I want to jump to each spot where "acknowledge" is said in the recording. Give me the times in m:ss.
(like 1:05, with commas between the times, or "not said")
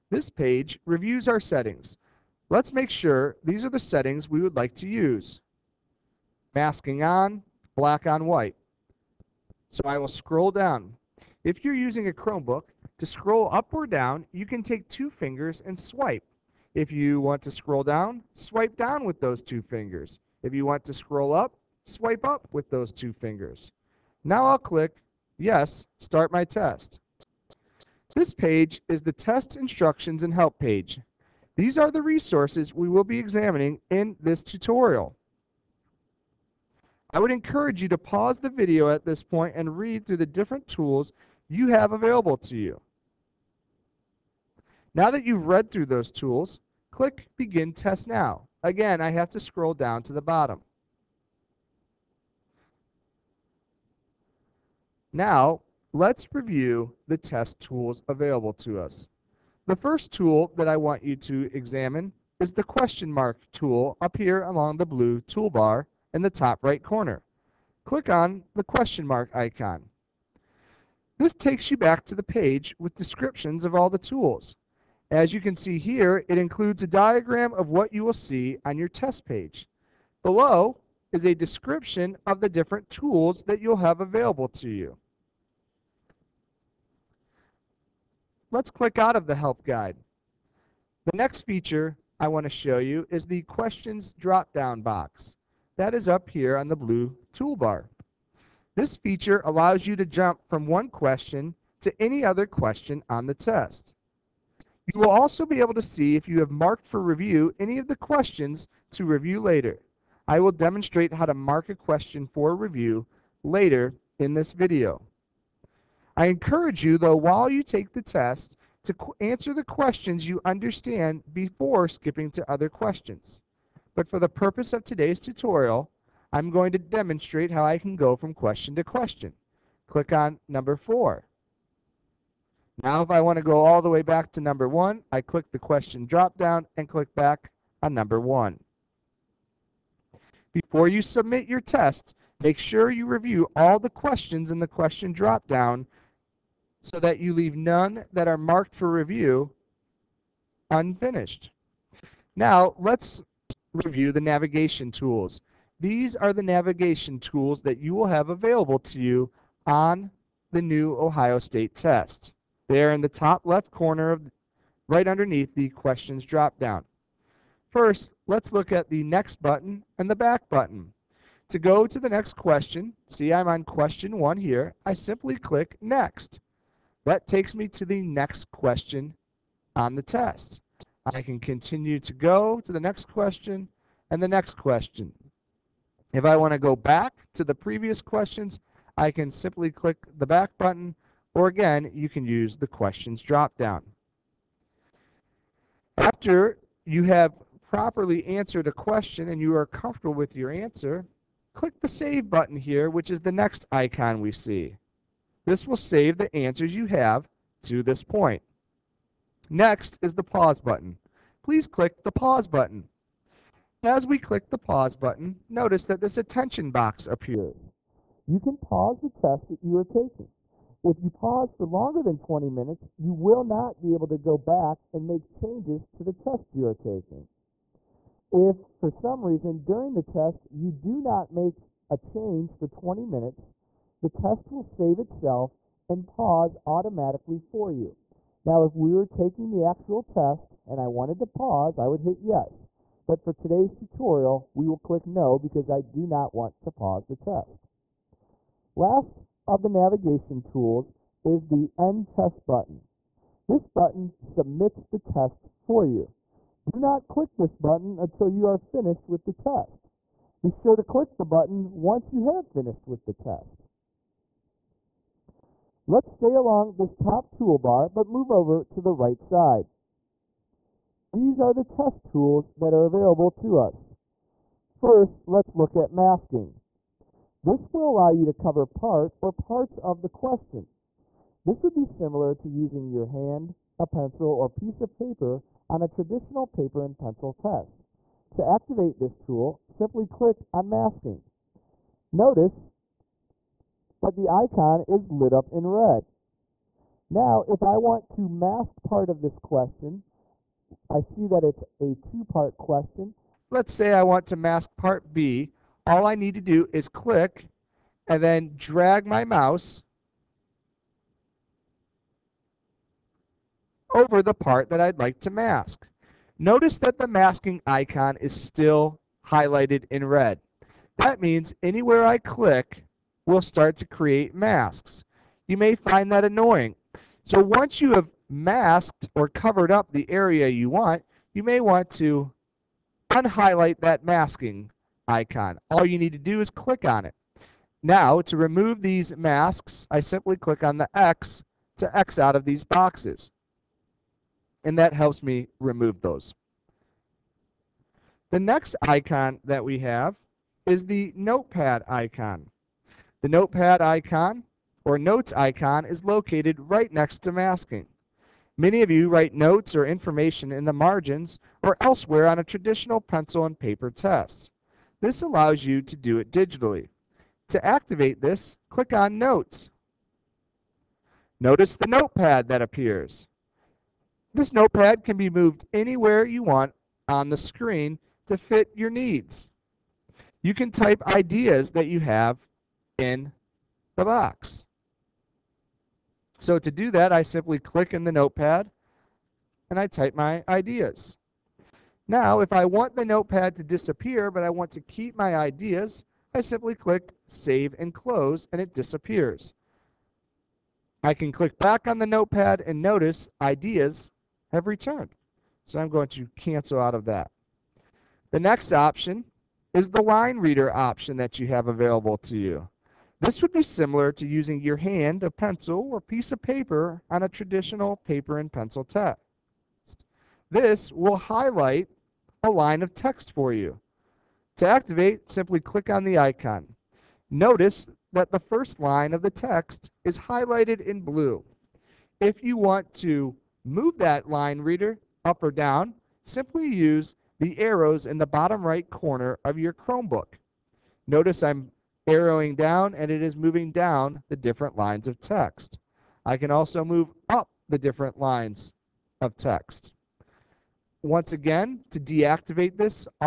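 not said.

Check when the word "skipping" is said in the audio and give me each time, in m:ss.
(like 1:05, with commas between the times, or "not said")
2:01.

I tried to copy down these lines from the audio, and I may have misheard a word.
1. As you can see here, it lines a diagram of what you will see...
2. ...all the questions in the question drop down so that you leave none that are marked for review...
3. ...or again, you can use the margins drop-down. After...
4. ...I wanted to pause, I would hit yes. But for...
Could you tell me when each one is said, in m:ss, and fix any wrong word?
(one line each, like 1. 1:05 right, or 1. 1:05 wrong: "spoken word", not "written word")
1. 1:15 wrong: "includes", not "lines"
2. 2:23 right
3. 3:11 wrong: "questions", not "margins"
4. 4:00 right.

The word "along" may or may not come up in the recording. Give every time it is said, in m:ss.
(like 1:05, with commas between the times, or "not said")
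1:04, 4:26.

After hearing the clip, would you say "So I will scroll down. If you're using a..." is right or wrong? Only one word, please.
right.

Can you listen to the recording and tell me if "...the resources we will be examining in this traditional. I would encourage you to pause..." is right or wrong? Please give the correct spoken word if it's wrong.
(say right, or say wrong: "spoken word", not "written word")
wrong: "tutorial", not "traditional".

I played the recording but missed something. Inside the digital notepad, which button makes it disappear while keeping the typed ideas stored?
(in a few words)
Save and Close.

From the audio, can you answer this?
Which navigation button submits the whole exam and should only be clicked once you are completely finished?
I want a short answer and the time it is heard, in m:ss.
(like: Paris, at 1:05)
End Test, at 4:11.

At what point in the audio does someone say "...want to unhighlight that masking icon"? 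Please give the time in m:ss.
5:31.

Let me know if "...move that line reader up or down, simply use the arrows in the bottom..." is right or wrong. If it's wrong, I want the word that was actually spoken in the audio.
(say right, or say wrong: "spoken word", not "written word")
right.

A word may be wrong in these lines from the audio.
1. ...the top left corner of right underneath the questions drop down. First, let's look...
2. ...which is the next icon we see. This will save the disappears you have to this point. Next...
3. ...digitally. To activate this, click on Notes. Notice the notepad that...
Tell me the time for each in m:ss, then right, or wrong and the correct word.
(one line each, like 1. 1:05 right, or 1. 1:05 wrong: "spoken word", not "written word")
1. 2:43 right
2. 3:22 wrong: "answers", not "disappears"
3. 6:06 right.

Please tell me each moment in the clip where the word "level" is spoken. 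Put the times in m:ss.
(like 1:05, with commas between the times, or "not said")
not said.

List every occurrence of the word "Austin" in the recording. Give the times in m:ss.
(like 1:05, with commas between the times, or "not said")
not said.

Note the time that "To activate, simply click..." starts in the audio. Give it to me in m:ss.
7:04.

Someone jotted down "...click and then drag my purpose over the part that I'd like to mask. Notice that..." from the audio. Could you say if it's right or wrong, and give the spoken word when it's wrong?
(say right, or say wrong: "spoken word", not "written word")
wrong: "mouse", not "purpose".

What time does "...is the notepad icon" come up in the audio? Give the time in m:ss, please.
5:50.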